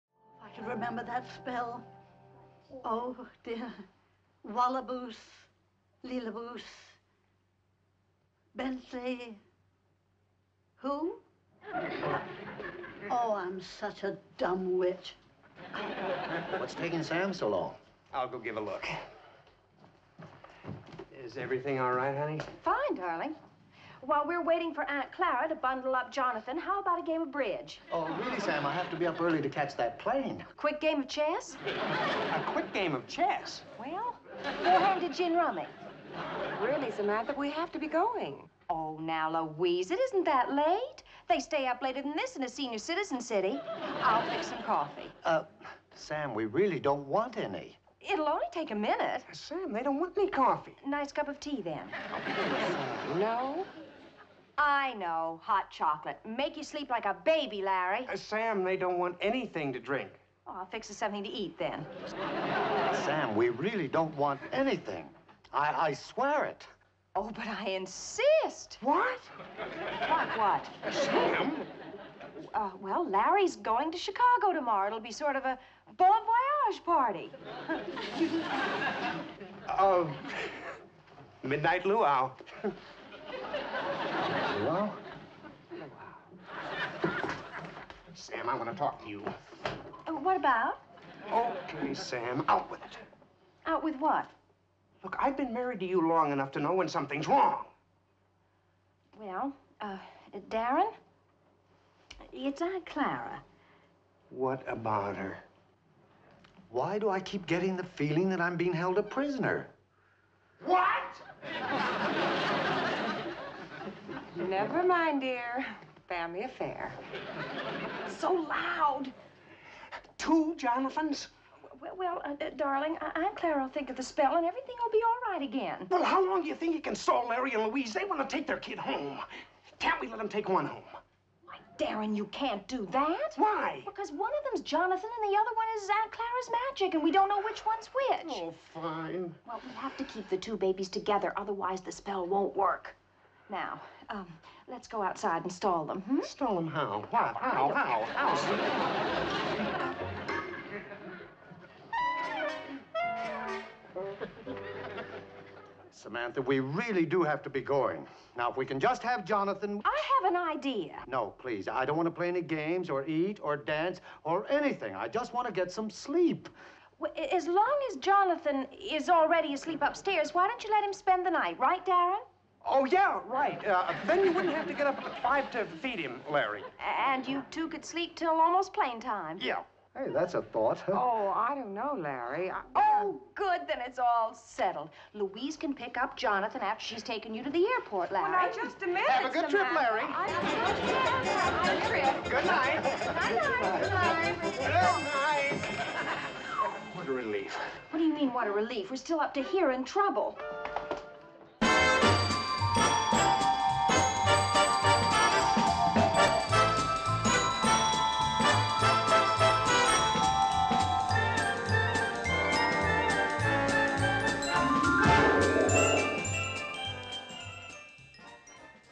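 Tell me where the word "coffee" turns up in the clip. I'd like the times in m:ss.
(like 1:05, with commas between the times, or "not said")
0:44, 0:50.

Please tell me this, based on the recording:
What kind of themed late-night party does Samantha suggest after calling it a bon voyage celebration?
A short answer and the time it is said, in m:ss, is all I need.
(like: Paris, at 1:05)
Midnight luau, at 1:21.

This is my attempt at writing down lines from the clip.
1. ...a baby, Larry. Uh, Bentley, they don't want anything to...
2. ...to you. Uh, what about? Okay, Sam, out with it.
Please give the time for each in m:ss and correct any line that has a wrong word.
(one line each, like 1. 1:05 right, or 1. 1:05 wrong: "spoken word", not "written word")
1. 0:57 wrong: "Sam", not "Bentley"
2. 1:29 right.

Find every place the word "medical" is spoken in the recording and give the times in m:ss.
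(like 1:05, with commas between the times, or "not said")
not said.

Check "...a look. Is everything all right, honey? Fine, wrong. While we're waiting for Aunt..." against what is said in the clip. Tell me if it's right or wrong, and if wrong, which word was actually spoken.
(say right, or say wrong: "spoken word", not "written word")
wrong: "darling", not "wrong".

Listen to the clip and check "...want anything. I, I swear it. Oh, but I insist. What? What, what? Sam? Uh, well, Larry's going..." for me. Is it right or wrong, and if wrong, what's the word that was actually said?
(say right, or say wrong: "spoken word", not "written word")
right.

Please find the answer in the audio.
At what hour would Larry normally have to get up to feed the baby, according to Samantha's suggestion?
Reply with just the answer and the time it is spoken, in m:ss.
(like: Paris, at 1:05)
5, at 2:55.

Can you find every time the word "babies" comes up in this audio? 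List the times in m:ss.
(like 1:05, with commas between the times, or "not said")
2:20.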